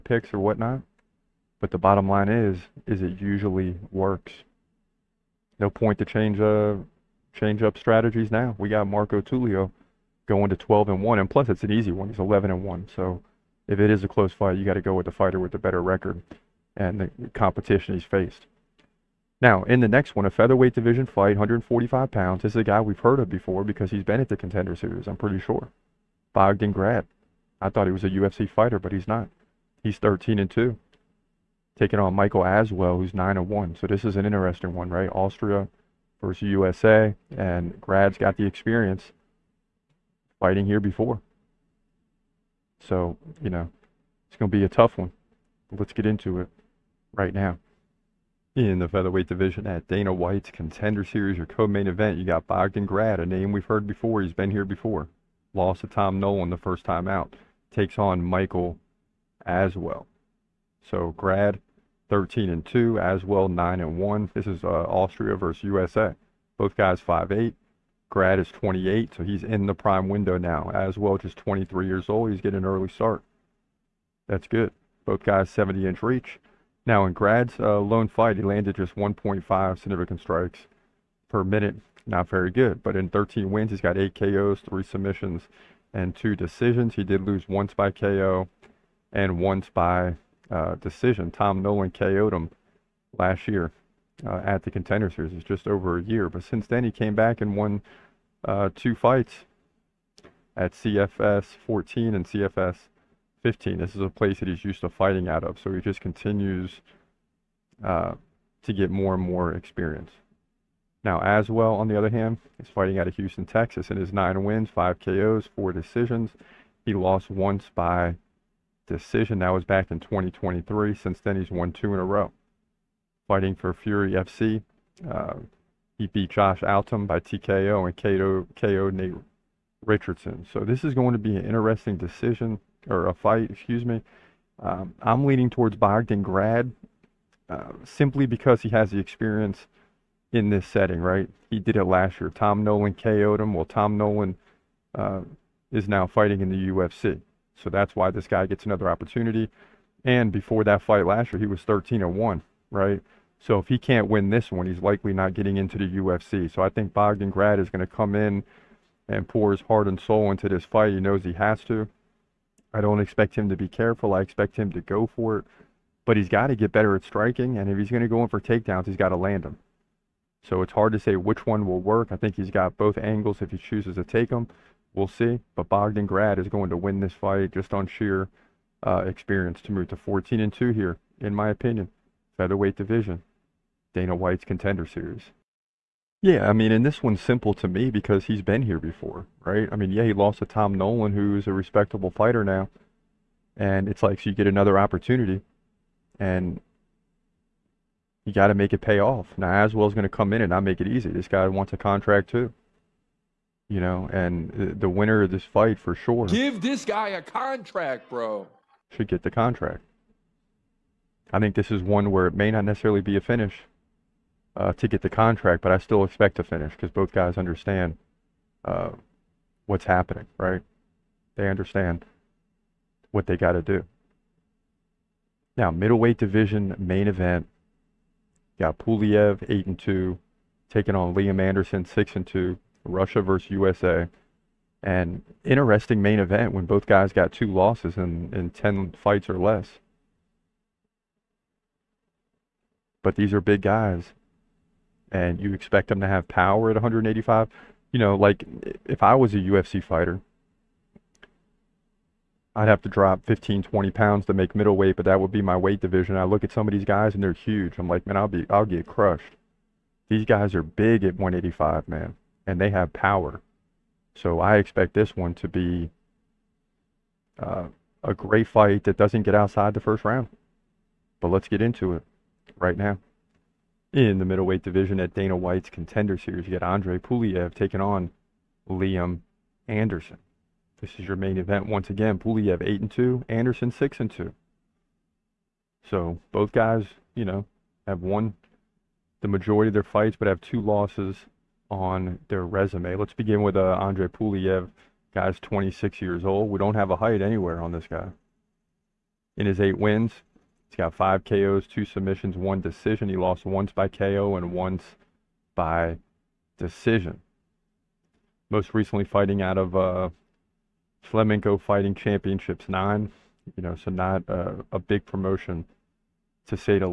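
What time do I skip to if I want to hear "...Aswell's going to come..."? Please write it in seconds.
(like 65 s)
199 s.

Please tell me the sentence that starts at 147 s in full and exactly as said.
So that's why this guy gets another opportunity.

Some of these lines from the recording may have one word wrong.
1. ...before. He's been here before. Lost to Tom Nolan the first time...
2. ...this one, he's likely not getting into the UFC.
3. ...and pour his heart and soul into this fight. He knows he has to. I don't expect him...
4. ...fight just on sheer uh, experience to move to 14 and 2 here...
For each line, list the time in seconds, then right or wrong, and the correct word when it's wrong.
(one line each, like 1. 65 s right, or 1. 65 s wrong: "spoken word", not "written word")
1. 53 s right
2. 154 s right
3. 159 s right
4. 177 s right.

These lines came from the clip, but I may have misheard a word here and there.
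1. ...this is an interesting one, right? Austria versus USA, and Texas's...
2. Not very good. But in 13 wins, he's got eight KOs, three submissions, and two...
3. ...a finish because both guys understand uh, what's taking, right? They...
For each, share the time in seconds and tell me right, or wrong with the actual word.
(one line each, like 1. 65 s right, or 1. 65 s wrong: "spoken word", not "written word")
1. 33 s wrong: "Grad", not "Texas"
2. 82 s right
3. 216 s wrong: "happening", not "taking".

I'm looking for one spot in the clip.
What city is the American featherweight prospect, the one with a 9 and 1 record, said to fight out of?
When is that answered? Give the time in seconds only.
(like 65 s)
113 s.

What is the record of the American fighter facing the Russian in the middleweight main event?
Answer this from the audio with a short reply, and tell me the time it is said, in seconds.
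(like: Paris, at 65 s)
6 and 2, at 231 s.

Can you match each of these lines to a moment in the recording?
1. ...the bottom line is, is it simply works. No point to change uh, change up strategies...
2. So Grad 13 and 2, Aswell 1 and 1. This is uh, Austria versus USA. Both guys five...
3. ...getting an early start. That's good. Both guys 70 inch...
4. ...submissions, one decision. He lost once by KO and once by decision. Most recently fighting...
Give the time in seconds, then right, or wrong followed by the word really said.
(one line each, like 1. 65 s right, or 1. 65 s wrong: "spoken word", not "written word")
1. 1 s wrong: "usually", not "simply"
2. 60 s wrong: "9", not "1"
3. 72 s right
4. 301 s right.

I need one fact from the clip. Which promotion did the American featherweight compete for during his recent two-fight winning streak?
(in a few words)
Fury FC.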